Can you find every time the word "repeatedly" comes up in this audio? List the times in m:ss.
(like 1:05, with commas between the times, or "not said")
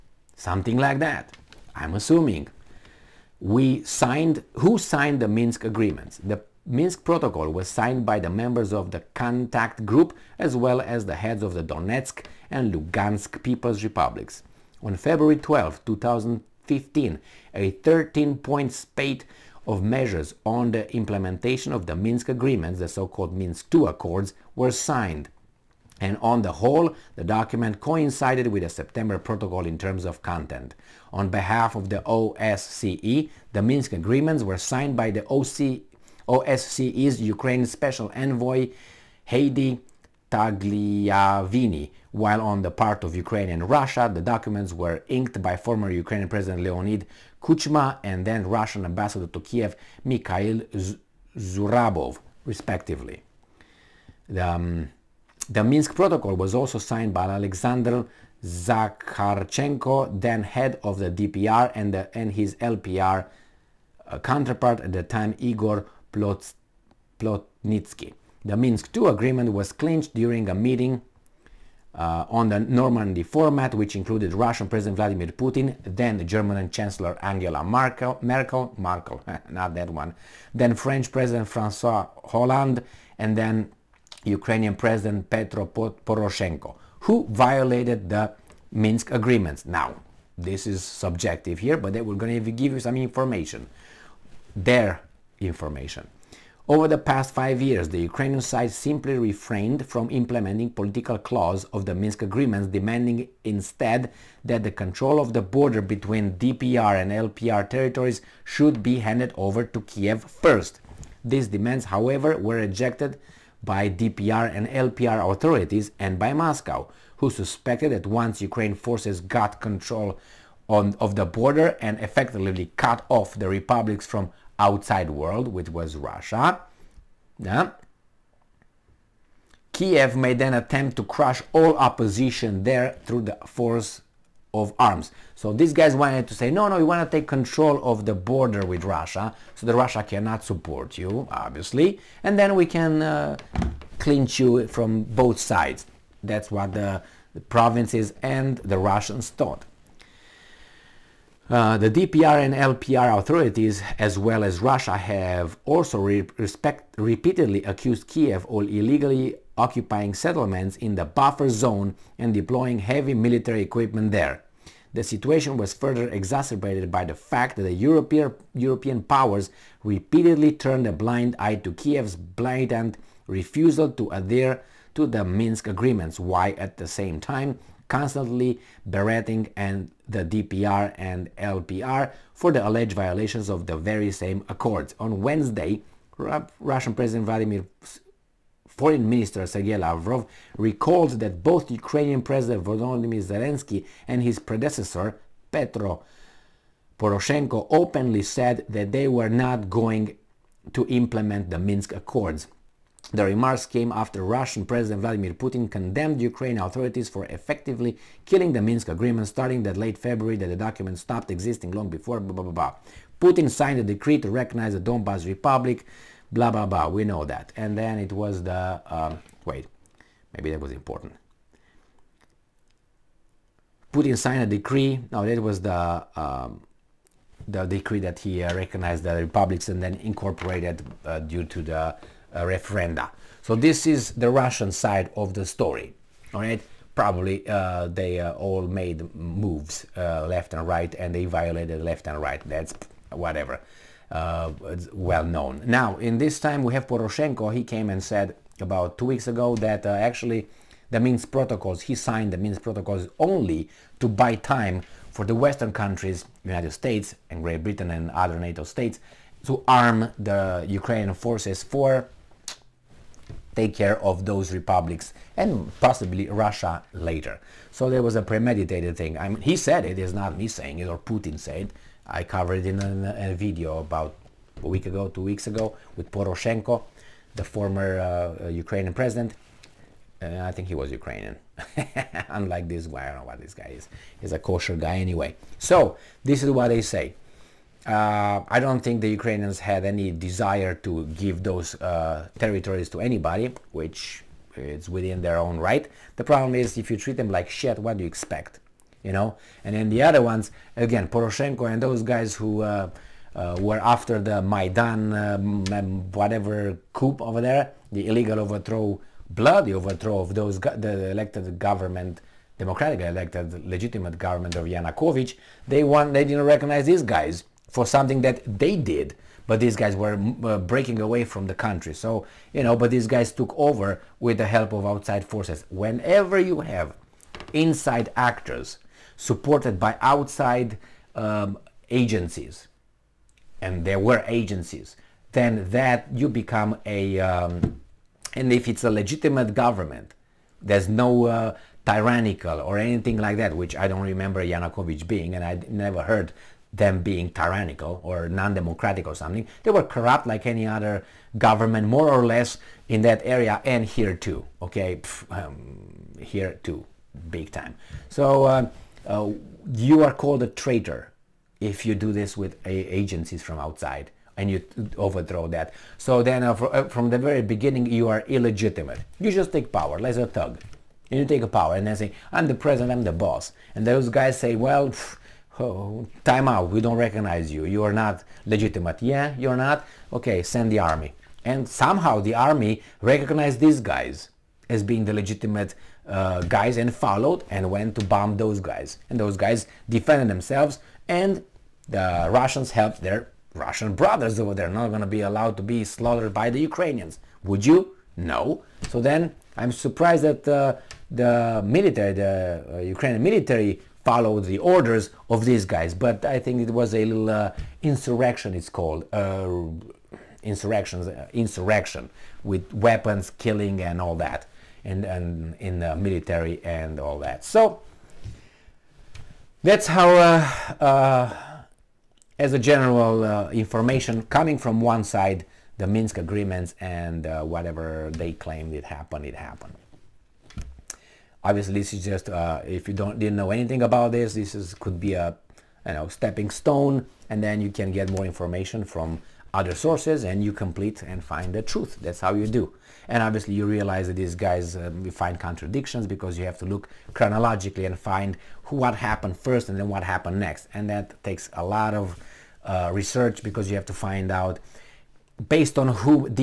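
2:36, 2:49.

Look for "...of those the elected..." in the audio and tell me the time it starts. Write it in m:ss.
5:10.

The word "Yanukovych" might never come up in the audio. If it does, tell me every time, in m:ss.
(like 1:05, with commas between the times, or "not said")
5:14, 5:44.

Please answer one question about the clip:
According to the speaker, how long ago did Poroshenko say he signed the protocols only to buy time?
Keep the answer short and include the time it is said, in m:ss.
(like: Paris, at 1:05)
About two weeks, at 4:08.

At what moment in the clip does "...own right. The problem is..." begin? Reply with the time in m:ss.
4:55.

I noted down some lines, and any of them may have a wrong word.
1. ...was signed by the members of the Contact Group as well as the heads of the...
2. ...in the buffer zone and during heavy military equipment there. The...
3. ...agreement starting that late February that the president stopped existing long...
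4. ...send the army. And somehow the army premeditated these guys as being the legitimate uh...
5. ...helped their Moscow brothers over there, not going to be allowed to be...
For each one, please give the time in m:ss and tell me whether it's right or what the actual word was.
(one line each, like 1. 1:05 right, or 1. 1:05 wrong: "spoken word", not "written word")
1. 0:07 right
2. 2:40 wrong: "deploying", not "during"
3. 3:28 wrong: "document", not "president"
4. 6:20 wrong: "recognized", not "premeditated"
5. 6:32 wrong: "Russian", not "Moscow".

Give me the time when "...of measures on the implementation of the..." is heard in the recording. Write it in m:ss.
0:19.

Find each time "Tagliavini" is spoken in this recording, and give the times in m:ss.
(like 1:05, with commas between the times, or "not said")
0:40.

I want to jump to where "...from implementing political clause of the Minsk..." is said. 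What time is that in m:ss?
1:39.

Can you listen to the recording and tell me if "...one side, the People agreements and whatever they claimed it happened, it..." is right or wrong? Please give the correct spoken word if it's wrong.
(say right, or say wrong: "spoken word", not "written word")
wrong: "Minsk", not "People".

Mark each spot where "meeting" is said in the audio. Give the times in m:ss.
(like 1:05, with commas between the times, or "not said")
1:10.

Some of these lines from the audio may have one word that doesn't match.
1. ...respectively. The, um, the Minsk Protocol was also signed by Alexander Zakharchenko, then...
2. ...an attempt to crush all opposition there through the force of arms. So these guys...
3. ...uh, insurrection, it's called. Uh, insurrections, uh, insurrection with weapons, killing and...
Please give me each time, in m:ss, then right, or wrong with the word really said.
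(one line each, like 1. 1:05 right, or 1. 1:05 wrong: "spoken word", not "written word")
1. 0:52 right
2. 2:10 right
3. 6:47 right.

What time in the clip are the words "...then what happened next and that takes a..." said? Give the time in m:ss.
7:29.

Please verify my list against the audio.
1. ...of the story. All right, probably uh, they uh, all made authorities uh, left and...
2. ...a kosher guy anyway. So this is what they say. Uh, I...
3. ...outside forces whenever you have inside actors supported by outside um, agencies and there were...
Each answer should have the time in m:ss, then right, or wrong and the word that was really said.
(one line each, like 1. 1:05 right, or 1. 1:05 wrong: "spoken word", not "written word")
1. 3:55 wrong: "moves", not "authorities"
2. 4:44 right
3. 5:24 right.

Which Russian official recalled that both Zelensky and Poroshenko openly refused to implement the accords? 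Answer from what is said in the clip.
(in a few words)
Sergei Lavrov.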